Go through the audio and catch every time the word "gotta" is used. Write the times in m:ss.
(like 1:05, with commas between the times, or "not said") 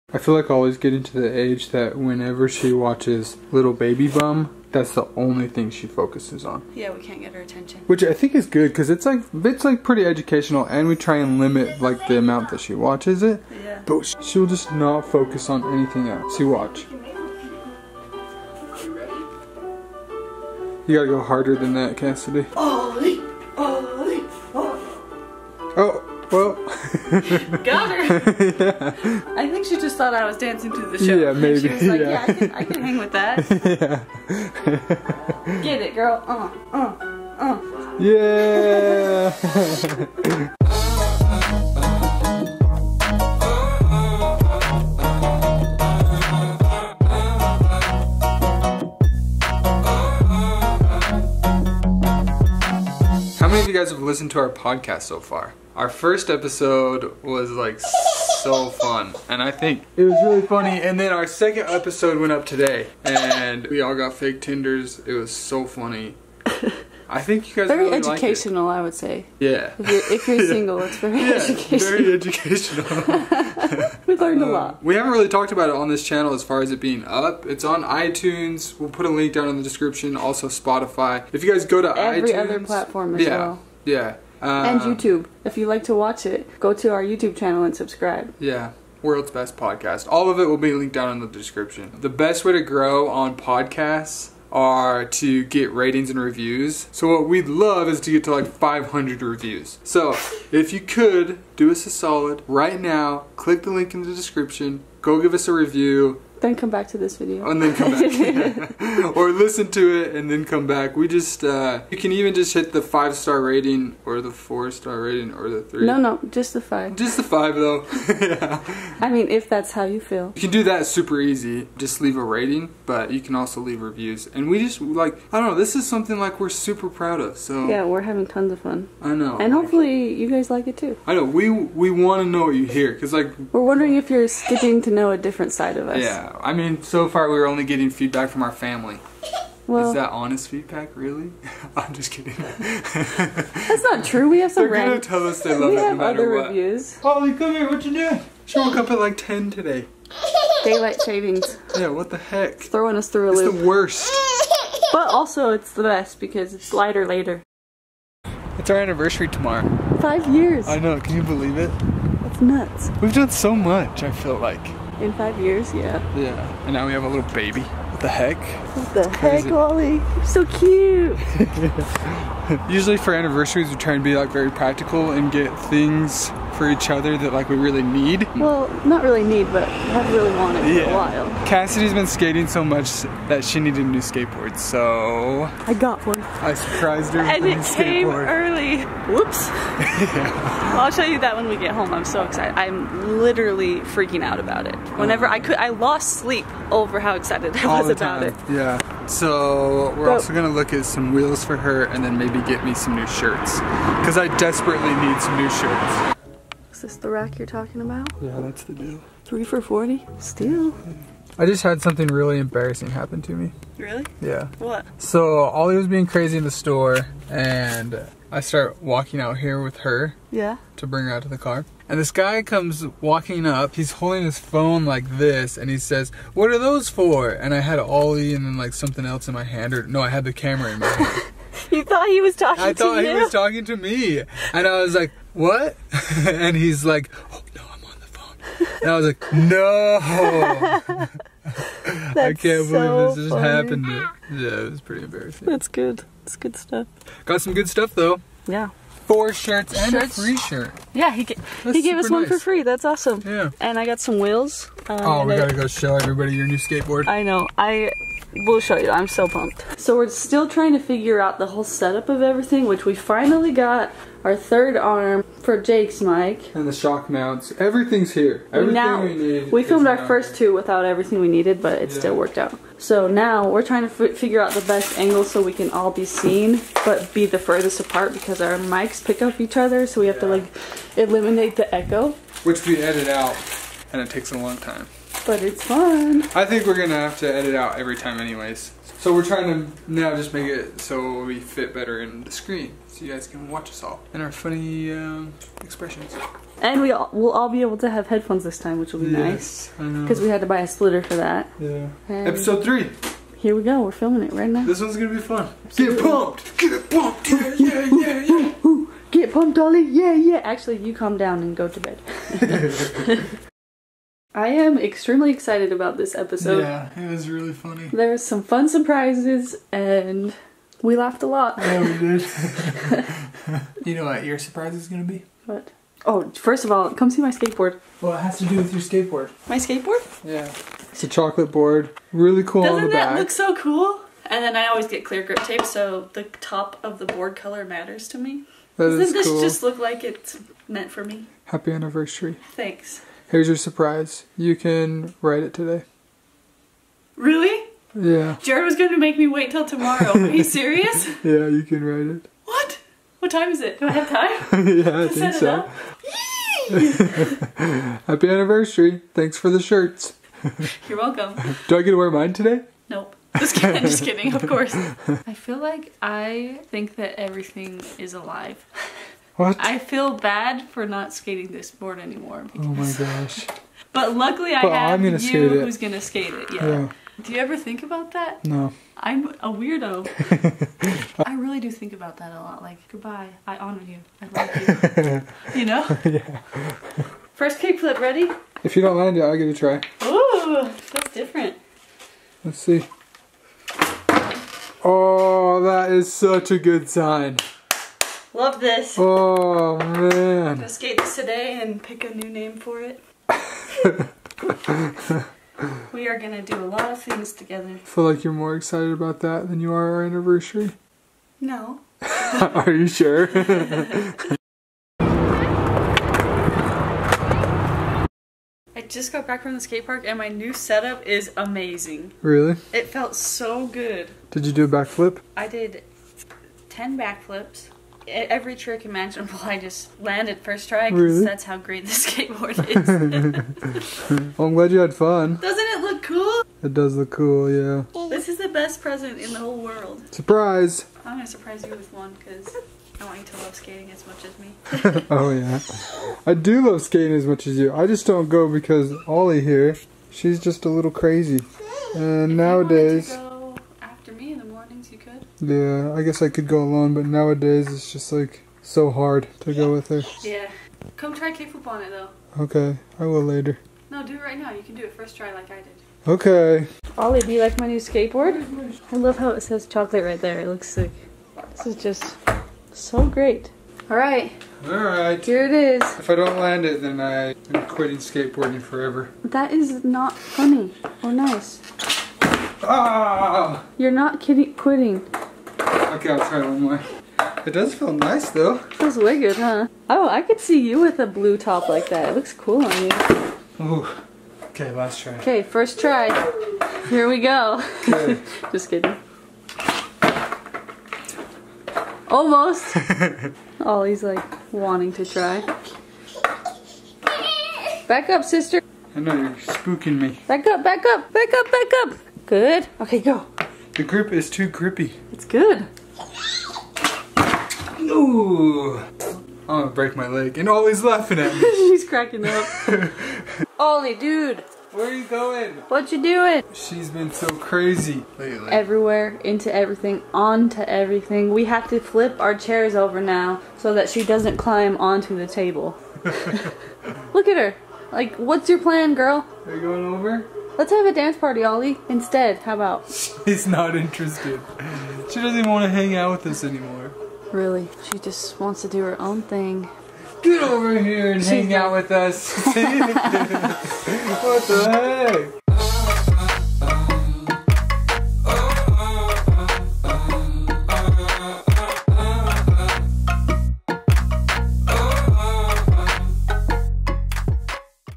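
0:20, 4:15.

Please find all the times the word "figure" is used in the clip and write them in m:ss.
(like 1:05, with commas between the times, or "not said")
4:20, 4:33.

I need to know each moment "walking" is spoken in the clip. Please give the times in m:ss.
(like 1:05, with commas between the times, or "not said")
3:38, 3:42.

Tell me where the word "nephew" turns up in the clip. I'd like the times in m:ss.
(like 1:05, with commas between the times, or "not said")
not said.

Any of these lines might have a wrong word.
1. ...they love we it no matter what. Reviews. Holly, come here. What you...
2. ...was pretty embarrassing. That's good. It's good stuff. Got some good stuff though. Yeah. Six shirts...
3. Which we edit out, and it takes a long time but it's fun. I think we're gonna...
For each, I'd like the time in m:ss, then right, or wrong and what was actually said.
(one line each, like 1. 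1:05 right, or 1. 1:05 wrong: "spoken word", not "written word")
1. 2:25 right
2. 4:04 wrong: "Four", not "Six"
3. 4:42 right.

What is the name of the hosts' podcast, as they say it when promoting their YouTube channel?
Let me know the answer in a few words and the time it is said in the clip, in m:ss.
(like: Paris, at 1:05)
World's Best Podcast, at 1:29.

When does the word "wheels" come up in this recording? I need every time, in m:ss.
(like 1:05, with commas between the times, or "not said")
3:21, 4:14.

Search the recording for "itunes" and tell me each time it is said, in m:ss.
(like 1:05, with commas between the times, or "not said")
1:17, 1:22.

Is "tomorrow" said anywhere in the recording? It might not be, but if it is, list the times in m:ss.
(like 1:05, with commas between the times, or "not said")
2:39, 5:49.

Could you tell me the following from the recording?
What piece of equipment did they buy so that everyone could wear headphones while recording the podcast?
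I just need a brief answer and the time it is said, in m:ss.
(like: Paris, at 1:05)
A splitter, at 5:00.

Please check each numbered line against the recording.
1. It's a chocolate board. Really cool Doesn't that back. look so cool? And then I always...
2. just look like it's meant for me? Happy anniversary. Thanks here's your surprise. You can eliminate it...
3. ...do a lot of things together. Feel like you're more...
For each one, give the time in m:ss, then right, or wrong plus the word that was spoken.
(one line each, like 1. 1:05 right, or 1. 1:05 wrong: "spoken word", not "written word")
1. 5:30 right
2. 5:39 wrong: "write", not "eliminate"
3. 6:46 right.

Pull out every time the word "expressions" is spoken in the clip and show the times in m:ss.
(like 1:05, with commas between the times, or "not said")
4:55.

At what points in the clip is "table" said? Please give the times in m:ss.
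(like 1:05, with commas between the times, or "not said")
8:55.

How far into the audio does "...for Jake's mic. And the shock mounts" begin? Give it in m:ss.
4:25.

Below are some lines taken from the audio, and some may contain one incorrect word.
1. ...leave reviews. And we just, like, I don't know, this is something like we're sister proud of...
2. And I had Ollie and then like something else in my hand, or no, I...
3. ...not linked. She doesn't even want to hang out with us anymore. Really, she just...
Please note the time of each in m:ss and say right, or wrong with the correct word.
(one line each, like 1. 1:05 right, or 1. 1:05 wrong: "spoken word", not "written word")
1. 2:03 wrong: "super", not "sister"
2. 3:47 right
3. 9:03 wrong: "interested", not "linked".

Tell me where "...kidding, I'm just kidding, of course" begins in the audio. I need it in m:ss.
6:03.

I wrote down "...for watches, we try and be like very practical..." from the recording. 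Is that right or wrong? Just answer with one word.
wrong.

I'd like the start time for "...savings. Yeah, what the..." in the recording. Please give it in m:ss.
2:31.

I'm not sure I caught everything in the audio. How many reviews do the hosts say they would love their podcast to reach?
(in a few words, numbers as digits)
500.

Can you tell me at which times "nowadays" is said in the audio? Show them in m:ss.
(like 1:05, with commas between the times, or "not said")
7:32, 7:37.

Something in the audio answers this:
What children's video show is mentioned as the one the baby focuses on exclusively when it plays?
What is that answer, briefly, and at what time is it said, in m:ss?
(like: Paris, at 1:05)
Little Baby Bum, at 0:03.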